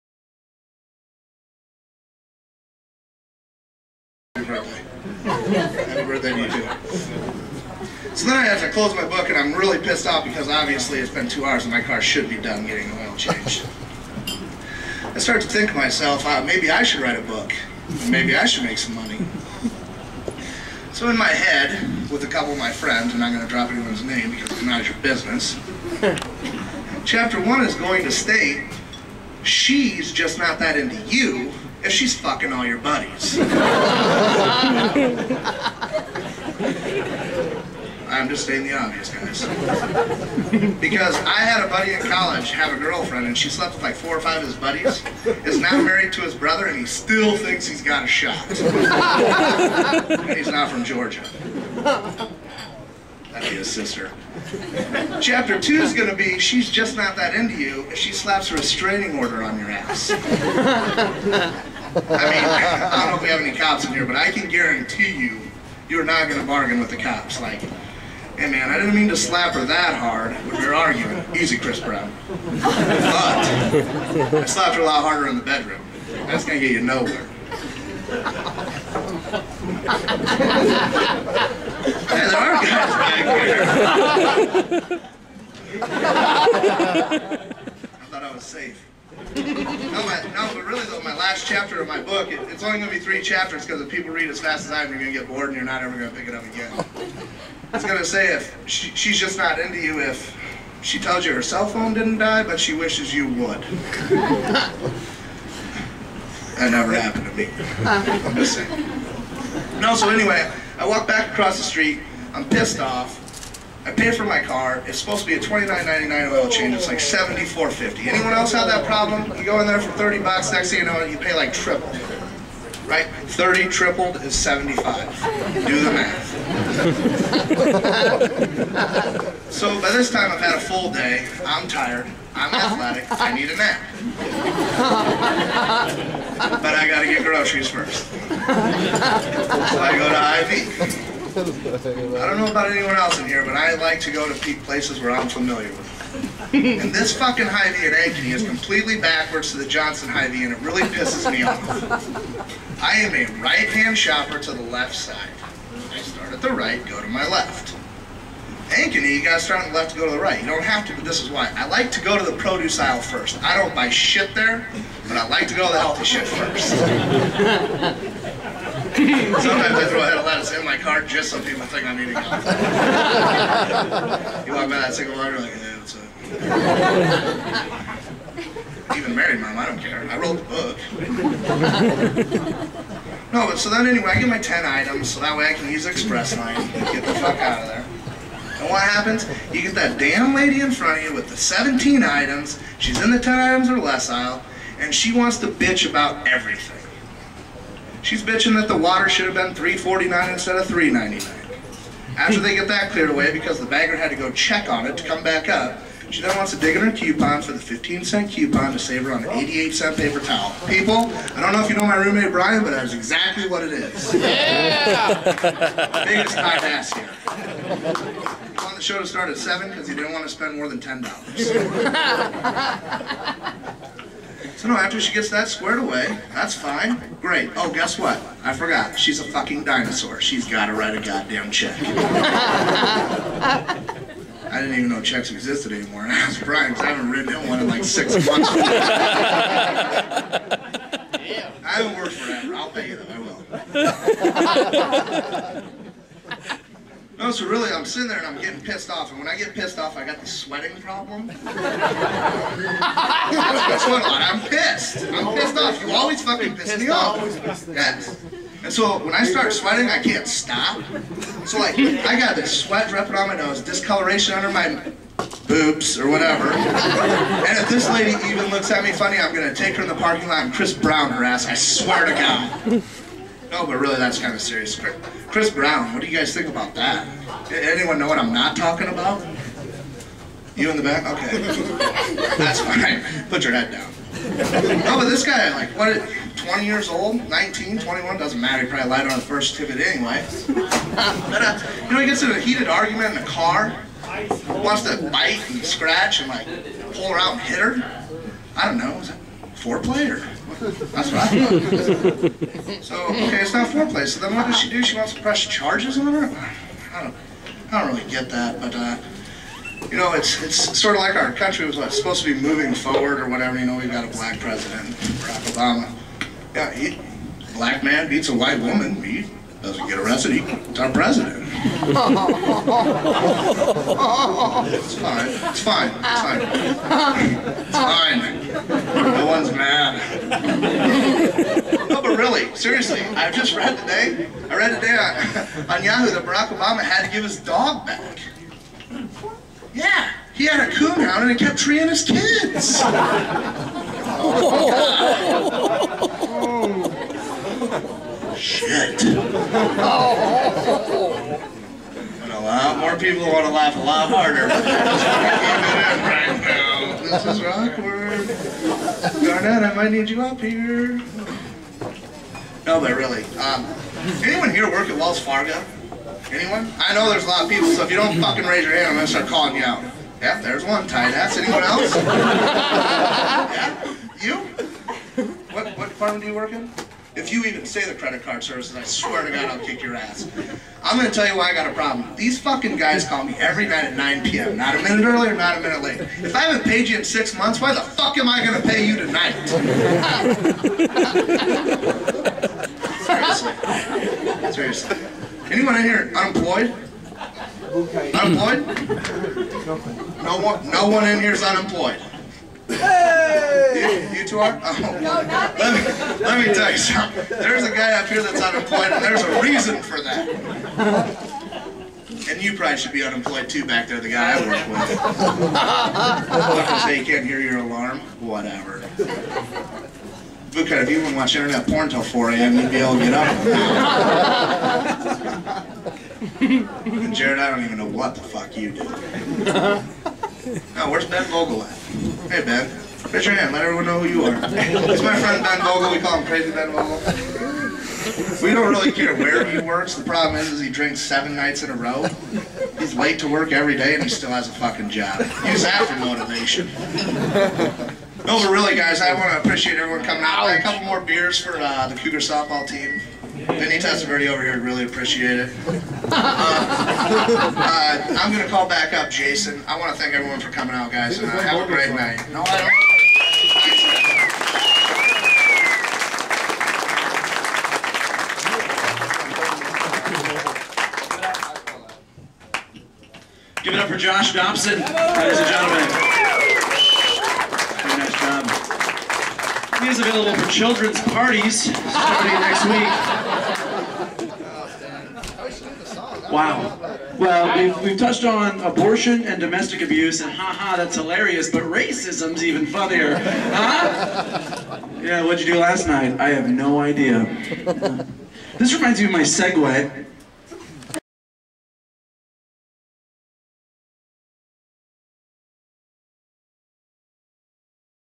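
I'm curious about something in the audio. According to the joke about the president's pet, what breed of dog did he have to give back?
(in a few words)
coonhound.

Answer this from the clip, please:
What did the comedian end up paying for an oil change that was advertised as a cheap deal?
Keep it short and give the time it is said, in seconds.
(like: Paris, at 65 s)
$74.50, at 116 s.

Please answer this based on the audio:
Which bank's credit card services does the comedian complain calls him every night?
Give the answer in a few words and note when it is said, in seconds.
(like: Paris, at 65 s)
Wells Fargo, at 364 s.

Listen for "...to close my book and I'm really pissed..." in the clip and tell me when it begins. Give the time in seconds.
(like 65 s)
8 s.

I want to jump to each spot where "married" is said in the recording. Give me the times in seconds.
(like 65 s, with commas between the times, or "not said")
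45 s, 179 s.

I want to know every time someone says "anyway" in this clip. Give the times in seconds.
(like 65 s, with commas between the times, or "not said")
110 s, 183 s, 289 s.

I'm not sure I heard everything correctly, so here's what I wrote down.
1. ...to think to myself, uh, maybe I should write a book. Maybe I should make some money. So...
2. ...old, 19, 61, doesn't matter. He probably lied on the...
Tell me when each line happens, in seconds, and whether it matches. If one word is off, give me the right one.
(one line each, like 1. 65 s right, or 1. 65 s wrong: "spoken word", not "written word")
1. 15 s right
2. 286 s wrong: "21", not "61".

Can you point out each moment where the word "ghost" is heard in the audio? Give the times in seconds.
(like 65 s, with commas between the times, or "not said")
not said.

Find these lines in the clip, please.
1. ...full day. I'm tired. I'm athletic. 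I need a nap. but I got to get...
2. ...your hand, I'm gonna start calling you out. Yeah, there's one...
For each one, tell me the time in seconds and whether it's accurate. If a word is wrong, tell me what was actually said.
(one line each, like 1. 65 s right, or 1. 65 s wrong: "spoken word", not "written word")
1. 130 s right
2. 368 s right.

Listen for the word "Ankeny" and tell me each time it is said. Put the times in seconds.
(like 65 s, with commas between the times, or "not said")
147 s, 158 s.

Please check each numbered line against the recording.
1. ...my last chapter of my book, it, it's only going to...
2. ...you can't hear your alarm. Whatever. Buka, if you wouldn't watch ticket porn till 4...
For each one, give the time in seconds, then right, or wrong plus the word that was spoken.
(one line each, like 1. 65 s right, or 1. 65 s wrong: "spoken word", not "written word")
1. 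91 s right
2. 416 s wrong: "internet", not "ticket".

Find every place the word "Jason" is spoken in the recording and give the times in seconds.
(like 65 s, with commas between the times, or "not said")
459 s.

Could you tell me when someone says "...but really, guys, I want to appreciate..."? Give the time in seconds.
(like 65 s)
448 s.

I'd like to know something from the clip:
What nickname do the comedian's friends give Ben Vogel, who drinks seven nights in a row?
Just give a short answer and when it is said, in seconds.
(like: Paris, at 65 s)
Crazy Ben Vogel, at 436 s.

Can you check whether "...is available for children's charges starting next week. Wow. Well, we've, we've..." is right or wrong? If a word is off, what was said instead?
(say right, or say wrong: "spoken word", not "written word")
wrong: "parties", not "charges".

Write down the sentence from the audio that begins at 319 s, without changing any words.
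You doesn't get arrested, He's our president.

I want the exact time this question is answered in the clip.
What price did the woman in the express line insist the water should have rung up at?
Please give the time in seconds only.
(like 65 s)
199 s.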